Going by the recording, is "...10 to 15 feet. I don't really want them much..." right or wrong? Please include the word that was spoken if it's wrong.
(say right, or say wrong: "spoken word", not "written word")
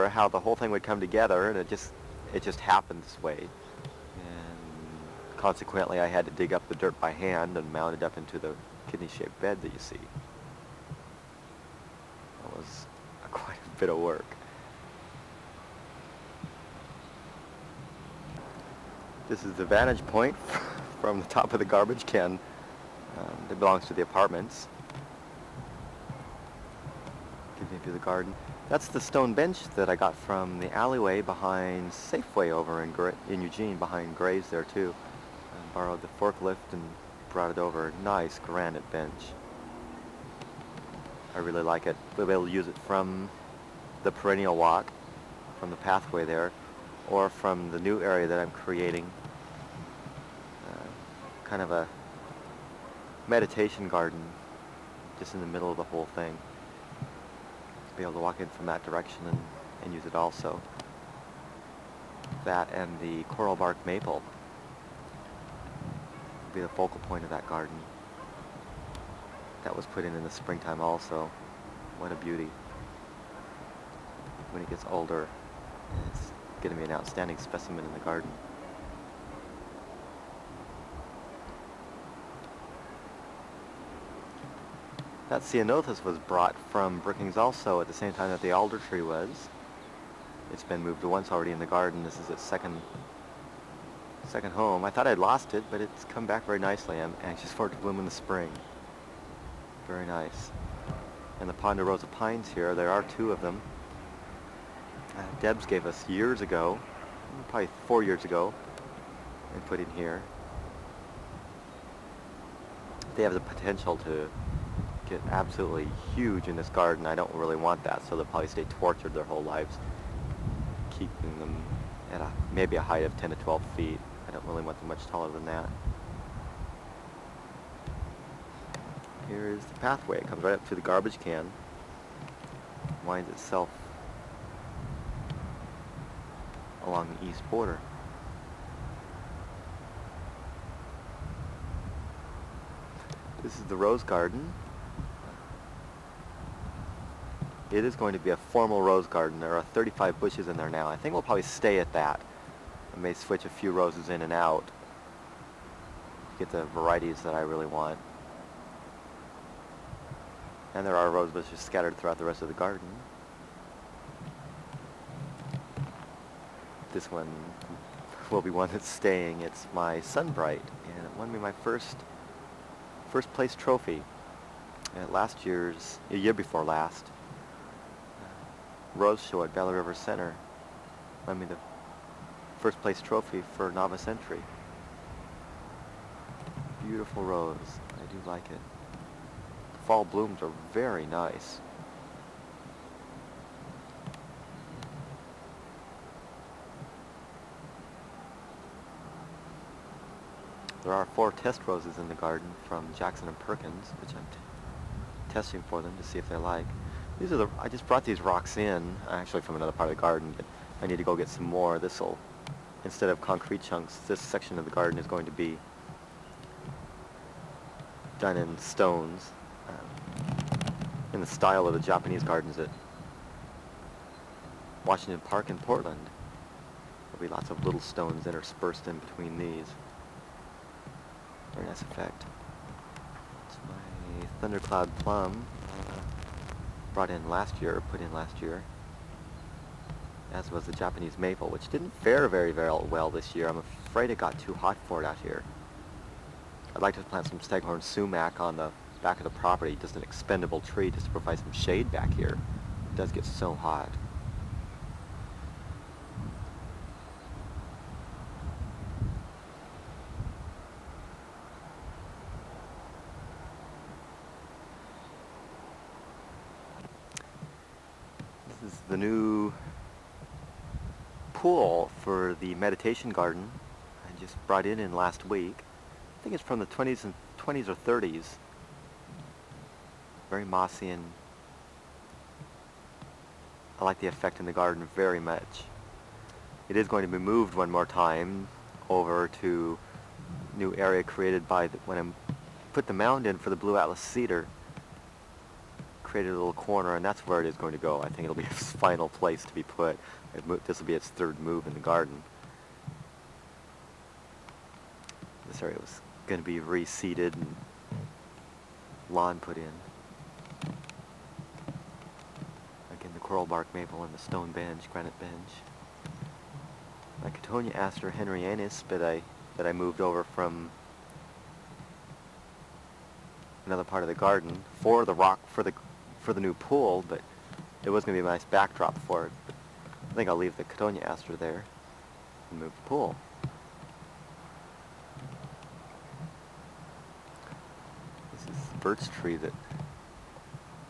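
wrong: "12", not "15".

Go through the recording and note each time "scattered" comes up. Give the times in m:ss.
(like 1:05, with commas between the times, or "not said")
2:41.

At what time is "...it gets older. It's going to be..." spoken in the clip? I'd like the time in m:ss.
1:14.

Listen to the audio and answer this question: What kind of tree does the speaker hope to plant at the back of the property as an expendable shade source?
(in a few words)
Staghorn Sumac.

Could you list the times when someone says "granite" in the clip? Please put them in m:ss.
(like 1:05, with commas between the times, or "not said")
0:38, 5:14.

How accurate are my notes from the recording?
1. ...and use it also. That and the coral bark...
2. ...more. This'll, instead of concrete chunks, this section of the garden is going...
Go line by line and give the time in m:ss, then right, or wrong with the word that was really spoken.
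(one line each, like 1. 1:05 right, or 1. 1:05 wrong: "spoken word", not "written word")
1. 0:59 right
2. 3:31 right.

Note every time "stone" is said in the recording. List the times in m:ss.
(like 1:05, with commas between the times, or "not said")
0:29, 3:38, 3:47, 5:14.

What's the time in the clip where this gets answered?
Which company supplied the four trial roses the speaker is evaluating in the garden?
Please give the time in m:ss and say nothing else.
3:22.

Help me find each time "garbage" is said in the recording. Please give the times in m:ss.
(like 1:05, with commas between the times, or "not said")
0:21, 2:10.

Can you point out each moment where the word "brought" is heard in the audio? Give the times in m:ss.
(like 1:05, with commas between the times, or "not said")
0:37, 1:26, 3:27, 3:56, 4:34.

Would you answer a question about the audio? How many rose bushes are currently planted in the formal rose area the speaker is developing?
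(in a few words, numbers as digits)
35.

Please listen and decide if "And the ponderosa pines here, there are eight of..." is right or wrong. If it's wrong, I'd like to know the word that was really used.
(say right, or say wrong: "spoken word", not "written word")
wrong: "two", not "eight".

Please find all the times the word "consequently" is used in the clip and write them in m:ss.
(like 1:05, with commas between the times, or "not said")
0:05.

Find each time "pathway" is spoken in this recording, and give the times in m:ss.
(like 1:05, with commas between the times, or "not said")
0:45, 2:09.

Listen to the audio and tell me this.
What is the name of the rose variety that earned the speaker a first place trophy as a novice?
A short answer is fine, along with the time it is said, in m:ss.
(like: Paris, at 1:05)
Sunbright, at 2:50.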